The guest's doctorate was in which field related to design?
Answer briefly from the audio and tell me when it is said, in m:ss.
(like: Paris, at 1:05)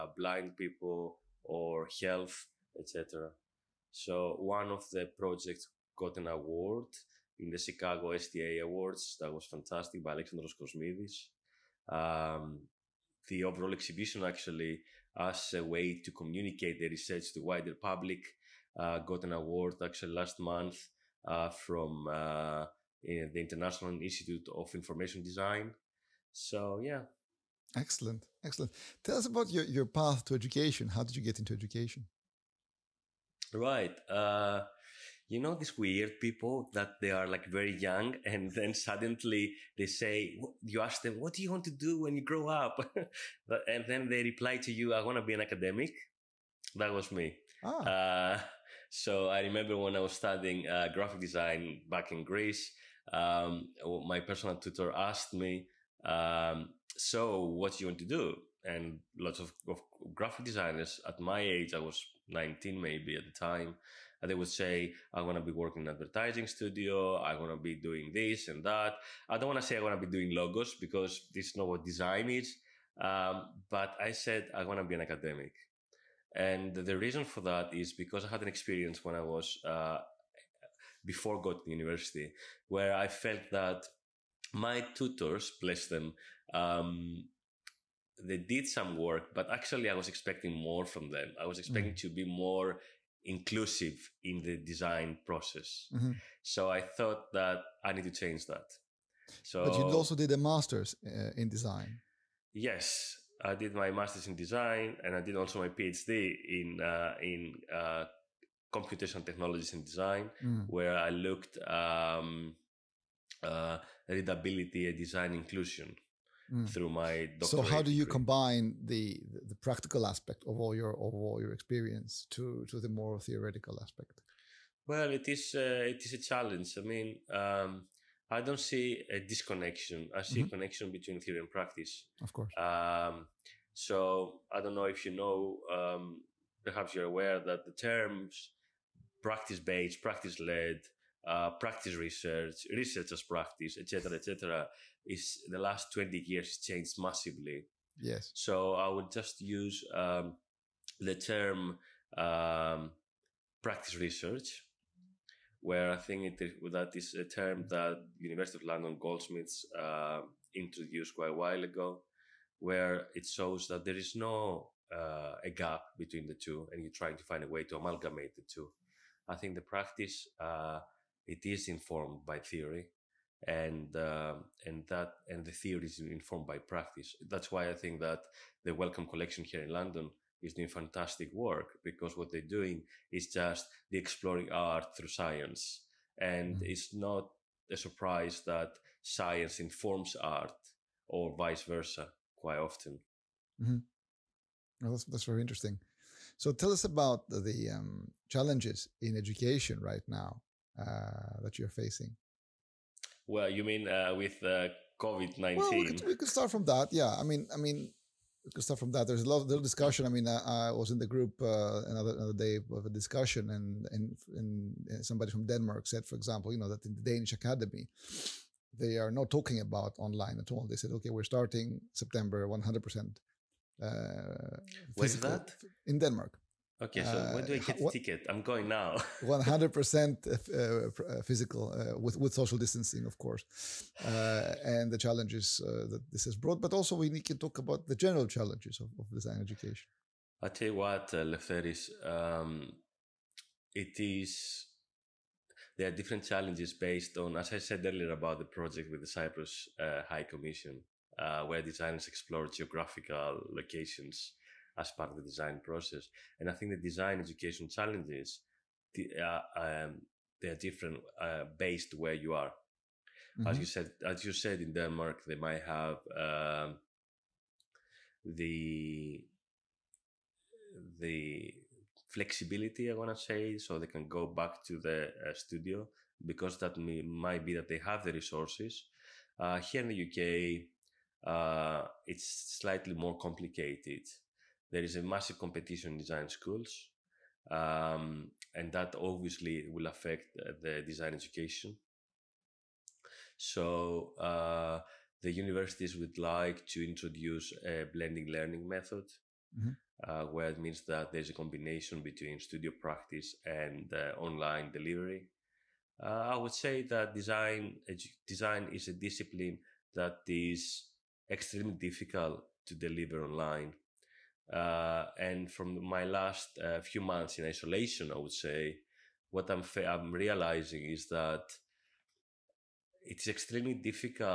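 Computational technologies in design, at 1:48.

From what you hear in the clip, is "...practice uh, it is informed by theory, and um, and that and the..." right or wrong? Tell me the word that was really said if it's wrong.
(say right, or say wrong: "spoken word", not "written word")
right.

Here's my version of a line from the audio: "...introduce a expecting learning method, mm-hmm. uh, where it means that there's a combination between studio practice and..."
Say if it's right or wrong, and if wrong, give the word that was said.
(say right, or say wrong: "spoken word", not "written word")
wrong: "blending", not "expecting".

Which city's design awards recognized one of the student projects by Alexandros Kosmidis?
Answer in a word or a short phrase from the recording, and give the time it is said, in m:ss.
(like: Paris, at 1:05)
Chicago, at 0:07.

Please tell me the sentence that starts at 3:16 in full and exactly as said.
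So tell us about the, the um, challenges in education right now uh, that you're facing.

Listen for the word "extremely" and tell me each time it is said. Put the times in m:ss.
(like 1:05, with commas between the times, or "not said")
5:11, 5:23.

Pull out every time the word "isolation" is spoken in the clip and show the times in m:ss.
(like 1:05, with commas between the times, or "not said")
5:17.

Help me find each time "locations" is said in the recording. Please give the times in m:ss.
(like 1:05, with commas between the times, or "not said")
4:13.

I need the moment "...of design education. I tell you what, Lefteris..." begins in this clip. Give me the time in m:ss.
3:58.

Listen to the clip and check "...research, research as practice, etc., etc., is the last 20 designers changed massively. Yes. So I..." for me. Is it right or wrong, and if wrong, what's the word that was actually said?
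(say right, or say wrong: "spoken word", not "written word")
wrong: "years", not "designers".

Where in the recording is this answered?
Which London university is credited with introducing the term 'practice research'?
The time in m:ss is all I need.
2:38.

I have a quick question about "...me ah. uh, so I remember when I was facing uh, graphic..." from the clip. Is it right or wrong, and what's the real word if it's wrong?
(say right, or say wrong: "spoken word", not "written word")
wrong: "studying", not "facing".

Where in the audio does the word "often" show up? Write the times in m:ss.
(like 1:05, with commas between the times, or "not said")
3:12.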